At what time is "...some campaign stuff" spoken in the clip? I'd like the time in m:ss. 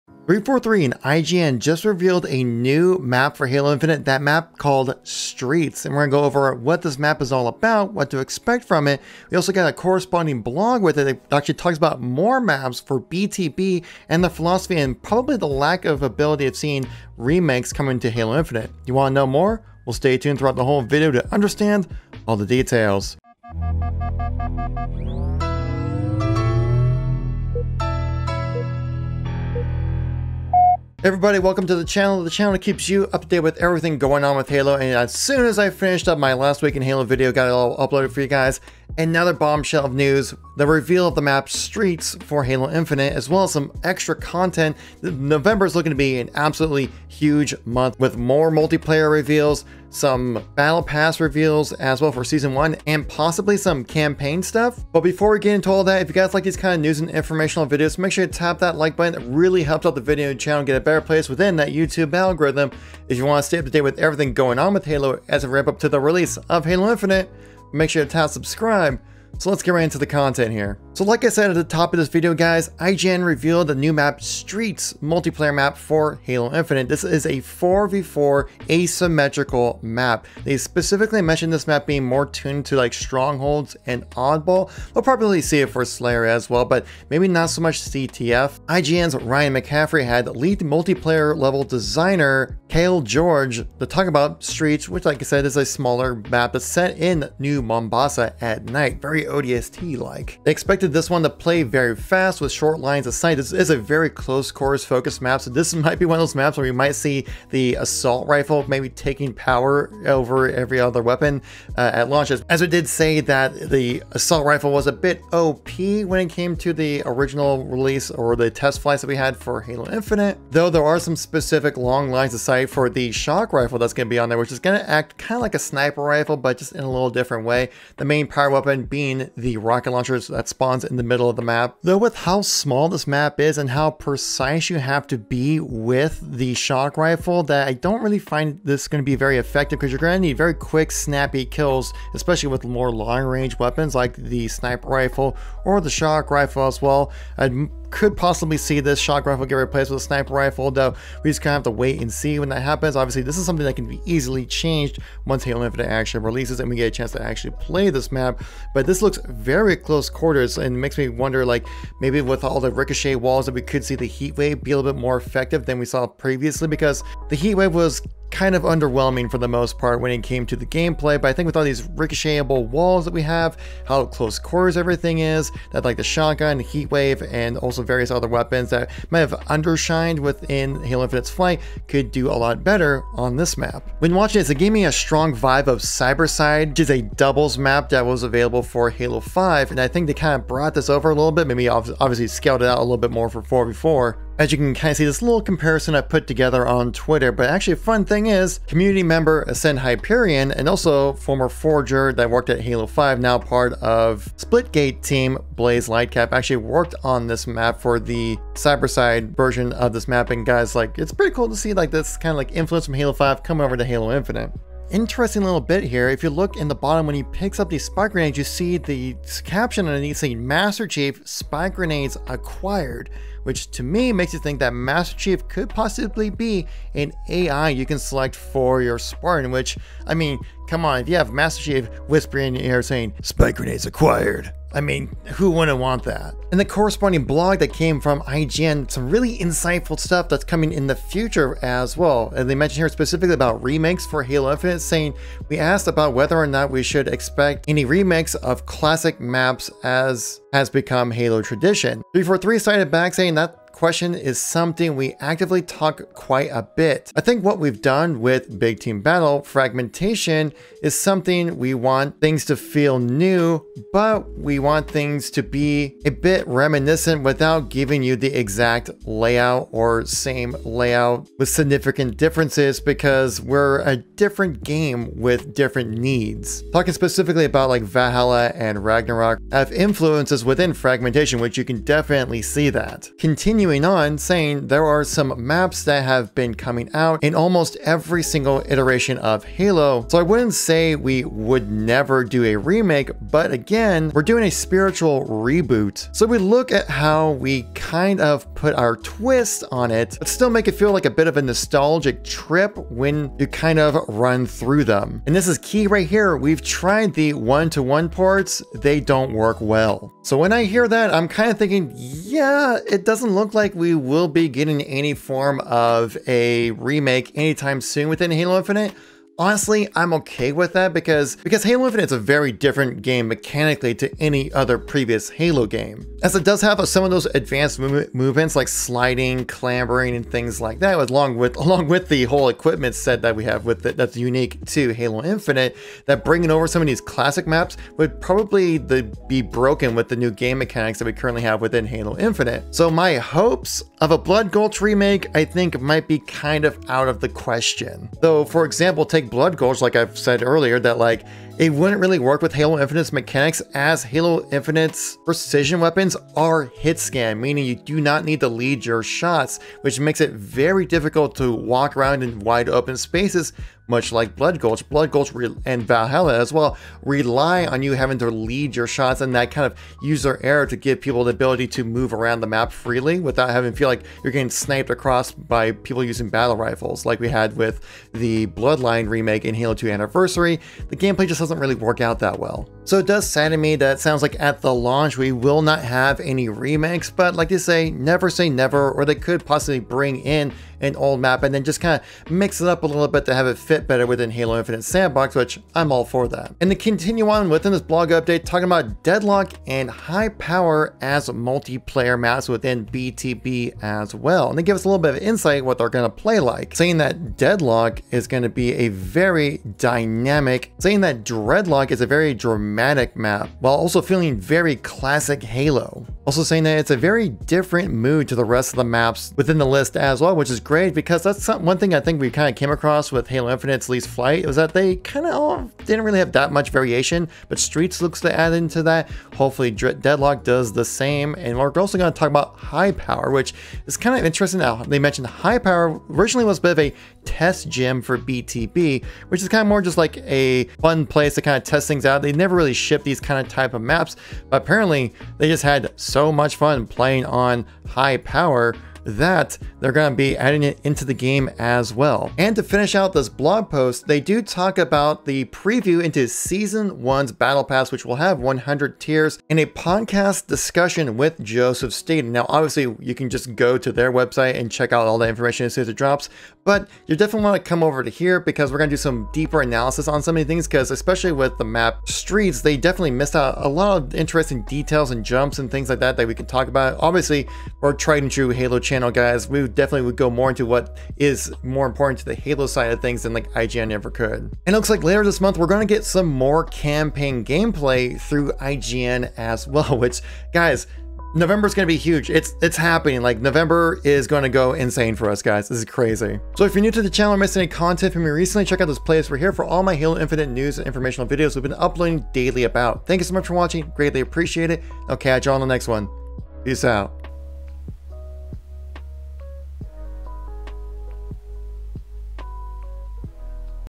0:53.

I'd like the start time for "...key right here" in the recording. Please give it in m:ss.
5:05.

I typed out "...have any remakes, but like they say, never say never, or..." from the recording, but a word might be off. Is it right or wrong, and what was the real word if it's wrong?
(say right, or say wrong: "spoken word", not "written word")
right.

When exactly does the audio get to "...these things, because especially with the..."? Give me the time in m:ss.
7:50.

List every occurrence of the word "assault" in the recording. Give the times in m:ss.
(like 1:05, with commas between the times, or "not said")
1:47, 1:54.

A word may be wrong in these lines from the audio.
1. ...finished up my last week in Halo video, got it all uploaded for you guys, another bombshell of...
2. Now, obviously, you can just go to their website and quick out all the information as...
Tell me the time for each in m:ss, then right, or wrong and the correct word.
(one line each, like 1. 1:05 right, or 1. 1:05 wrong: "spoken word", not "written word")
1. 0:35 right
2. 7:42 wrong: "check", not "quick".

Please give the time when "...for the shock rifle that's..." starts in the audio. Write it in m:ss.
2:02.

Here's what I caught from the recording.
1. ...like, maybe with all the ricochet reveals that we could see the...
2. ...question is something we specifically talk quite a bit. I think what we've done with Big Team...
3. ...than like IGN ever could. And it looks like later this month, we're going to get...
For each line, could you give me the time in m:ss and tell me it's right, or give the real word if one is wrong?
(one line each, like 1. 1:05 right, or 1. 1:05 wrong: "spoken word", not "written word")
1. 2:41 wrong: "walls", not "reveals"
2. 4:13 wrong: "actively", not "specifically"
3. 8:03 right.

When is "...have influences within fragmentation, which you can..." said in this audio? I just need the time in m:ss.
4:39.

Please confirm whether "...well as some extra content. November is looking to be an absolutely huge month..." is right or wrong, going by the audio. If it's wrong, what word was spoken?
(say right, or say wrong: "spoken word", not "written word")
right.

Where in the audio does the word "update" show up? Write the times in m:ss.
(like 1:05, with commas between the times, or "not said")
6:38.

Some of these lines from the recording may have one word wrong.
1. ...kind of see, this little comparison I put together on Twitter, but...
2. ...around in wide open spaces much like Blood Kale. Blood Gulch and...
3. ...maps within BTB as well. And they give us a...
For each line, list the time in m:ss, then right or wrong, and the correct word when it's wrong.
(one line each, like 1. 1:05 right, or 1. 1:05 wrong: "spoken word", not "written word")
1. 3:14 right
2. 6:01 wrong: "Gulch", not "Kale"
3. 6:42 right.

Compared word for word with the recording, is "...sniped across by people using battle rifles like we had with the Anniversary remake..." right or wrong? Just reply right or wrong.
wrong.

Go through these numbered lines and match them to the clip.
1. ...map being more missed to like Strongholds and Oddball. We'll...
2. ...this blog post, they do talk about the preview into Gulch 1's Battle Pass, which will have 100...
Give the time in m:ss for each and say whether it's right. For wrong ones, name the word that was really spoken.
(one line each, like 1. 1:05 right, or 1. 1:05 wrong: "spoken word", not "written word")
1. 1:21 wrong: "tuned", not "missed"
2. 7:33 wrong: "Season", not "Gulch".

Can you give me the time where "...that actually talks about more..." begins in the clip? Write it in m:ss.
0:11.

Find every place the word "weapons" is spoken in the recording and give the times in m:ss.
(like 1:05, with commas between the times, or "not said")
1:51, 2:08, 2:23, 2:58, 5:55.